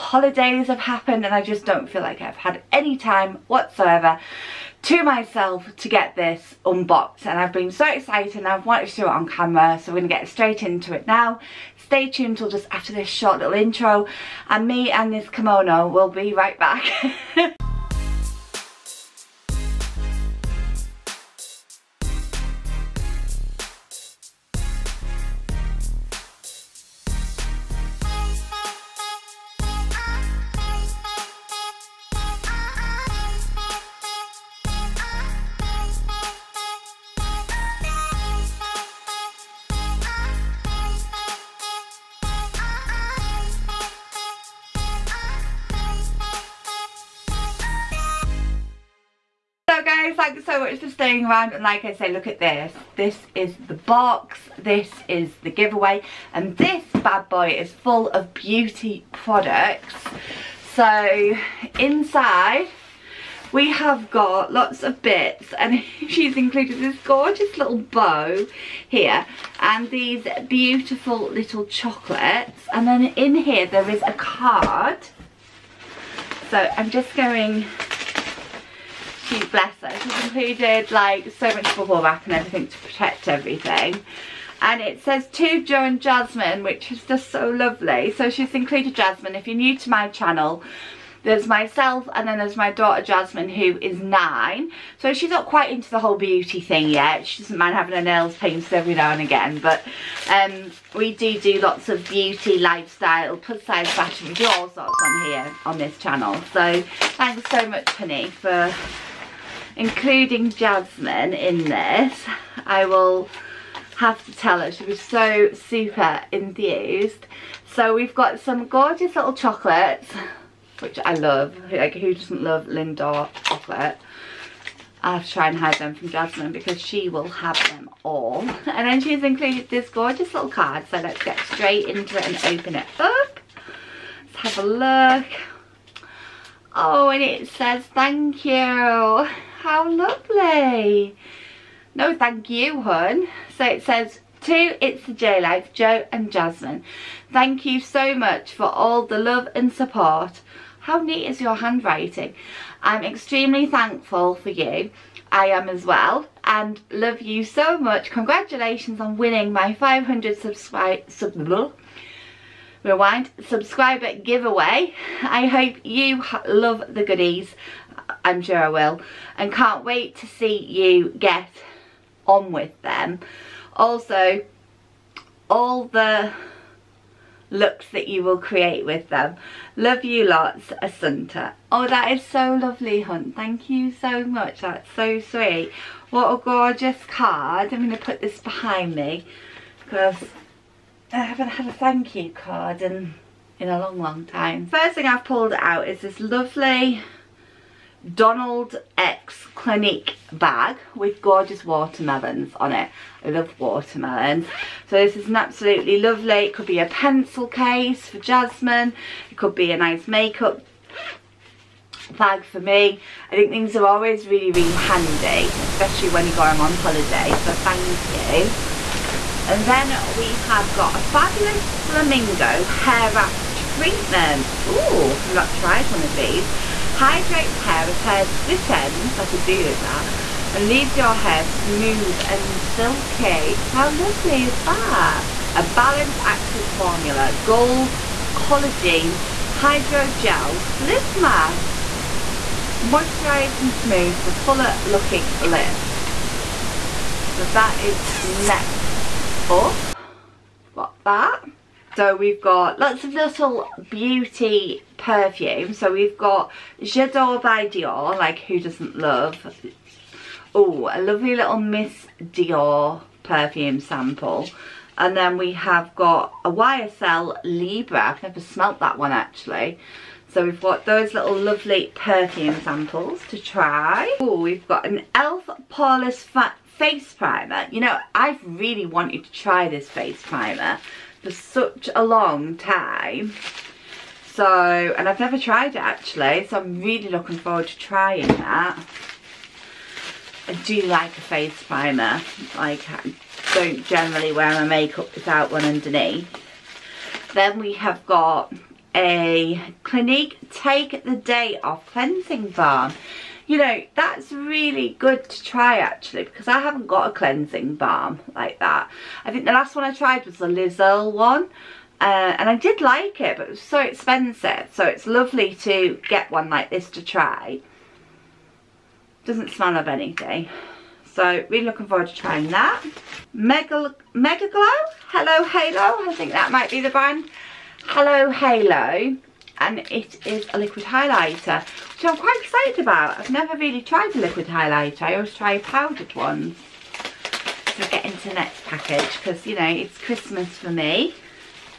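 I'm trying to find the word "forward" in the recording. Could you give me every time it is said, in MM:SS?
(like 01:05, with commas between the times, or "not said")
04:47, 05:21.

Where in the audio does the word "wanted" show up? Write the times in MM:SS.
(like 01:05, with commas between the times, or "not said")
00:08, 04:38.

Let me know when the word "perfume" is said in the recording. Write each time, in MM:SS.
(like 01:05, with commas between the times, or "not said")
04:14, 04:23, 04:31.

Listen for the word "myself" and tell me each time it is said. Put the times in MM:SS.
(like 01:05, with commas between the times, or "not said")
00:05, 01:31.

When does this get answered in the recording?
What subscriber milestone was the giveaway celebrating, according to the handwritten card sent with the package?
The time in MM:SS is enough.
02:39.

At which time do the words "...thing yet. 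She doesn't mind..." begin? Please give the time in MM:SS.
01:36.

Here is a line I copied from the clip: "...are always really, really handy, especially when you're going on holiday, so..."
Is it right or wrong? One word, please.
right.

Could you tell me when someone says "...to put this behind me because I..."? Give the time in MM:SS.
03:07.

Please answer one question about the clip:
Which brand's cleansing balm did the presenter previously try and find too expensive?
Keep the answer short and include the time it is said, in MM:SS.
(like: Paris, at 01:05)
Liz Earle, at 05:10.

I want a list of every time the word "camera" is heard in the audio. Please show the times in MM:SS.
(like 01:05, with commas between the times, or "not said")
00:09.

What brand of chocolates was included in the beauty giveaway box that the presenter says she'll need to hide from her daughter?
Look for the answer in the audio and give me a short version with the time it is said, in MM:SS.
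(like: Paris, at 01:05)
Lindor, at 02:02.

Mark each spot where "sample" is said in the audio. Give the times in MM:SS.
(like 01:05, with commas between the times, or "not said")
04:23, 04:32.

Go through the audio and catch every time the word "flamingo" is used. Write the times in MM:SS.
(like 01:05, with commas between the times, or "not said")
03:41.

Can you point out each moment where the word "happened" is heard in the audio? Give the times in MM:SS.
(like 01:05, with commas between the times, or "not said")
00:00.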